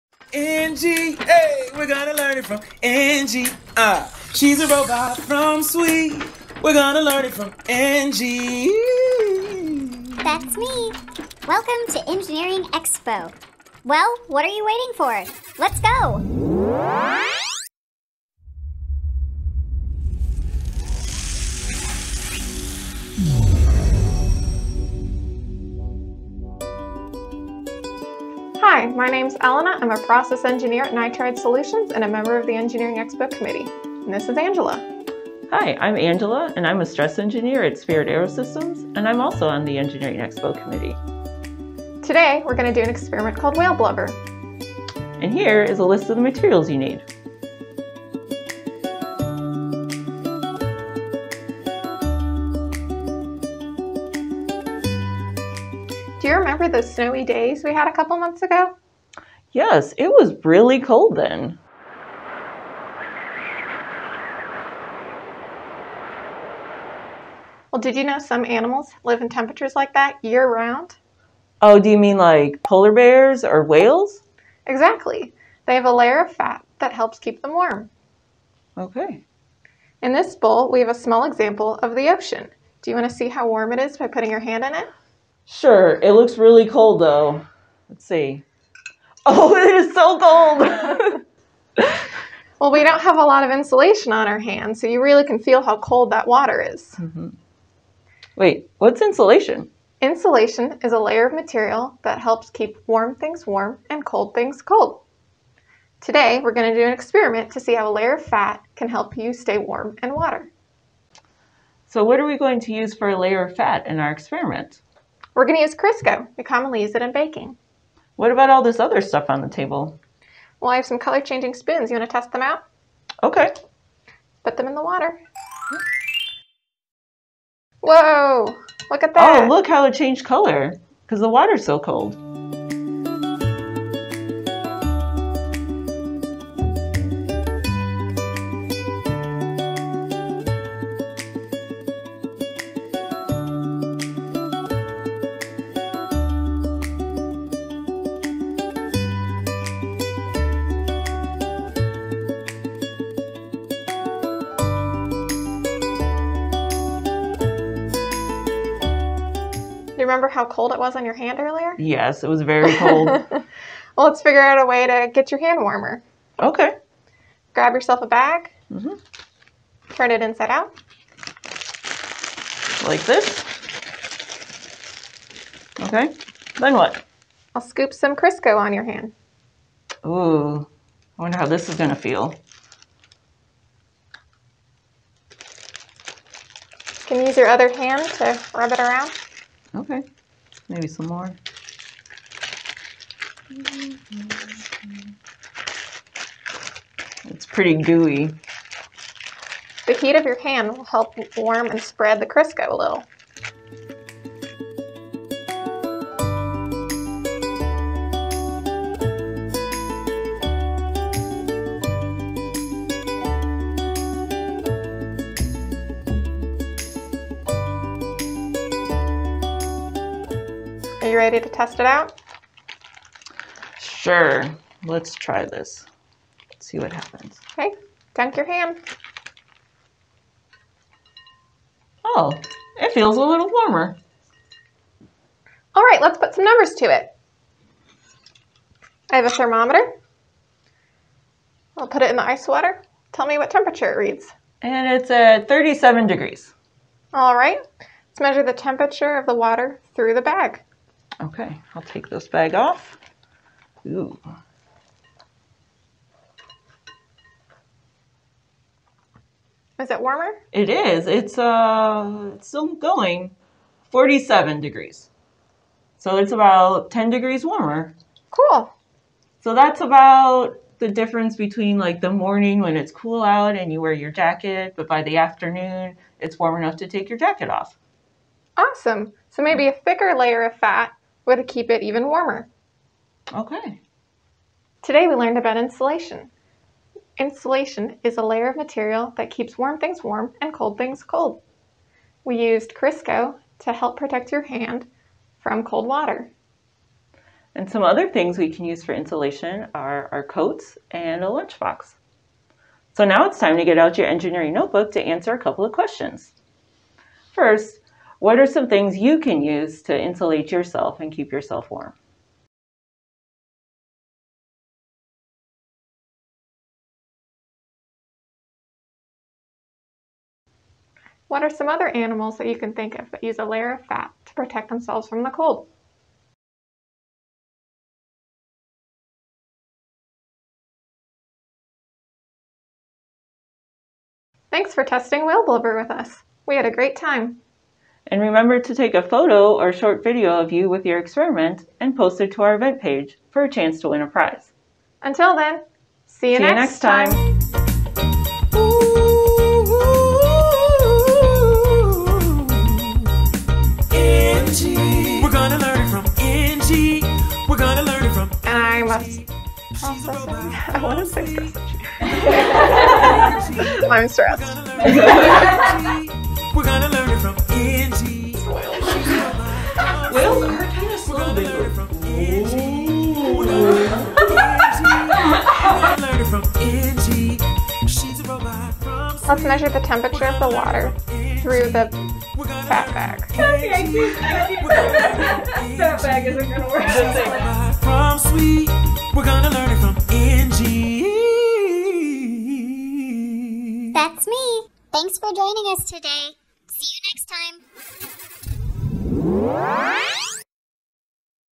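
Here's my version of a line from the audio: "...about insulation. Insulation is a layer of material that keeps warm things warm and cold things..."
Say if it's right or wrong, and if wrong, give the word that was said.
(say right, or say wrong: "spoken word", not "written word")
right.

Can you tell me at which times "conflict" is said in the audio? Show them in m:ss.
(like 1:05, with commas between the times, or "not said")
not said.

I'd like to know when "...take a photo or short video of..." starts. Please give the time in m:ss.
5:38.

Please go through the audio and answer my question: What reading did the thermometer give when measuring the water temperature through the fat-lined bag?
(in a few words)
47 degrees.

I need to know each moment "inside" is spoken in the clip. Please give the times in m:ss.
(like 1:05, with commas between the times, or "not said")
2:50.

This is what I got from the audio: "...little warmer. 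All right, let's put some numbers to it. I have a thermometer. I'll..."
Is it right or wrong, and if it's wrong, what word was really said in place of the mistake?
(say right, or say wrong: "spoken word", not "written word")
right.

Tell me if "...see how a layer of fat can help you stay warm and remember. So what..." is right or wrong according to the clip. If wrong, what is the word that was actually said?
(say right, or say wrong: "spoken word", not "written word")
wrong: "water", not "remember".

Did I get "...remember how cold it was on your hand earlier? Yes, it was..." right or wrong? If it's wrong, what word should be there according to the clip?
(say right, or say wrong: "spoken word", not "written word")
right.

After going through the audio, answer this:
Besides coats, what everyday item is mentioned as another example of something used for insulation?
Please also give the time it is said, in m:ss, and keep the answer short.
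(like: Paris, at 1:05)
lunchbox, at 5:01.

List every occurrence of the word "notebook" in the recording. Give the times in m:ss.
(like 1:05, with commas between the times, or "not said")
5:04.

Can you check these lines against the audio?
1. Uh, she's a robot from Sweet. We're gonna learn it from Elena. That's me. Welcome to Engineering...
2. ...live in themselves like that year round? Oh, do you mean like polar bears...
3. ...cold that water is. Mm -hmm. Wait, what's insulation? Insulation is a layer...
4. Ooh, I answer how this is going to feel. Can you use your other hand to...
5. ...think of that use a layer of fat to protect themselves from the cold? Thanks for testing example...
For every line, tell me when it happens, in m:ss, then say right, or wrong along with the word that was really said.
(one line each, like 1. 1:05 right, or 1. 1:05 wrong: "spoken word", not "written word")
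1. 0:03 wrong: "Engie", not "Elena"
2. 1:09 wrong: "temperatures", not "themselves"
3. 1:35 right
4. 3:00 wrong: "wonder", not "answer"
5. 5:22 wrong: "whale", not "example".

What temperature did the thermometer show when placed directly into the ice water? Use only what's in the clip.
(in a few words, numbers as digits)
37 degrees.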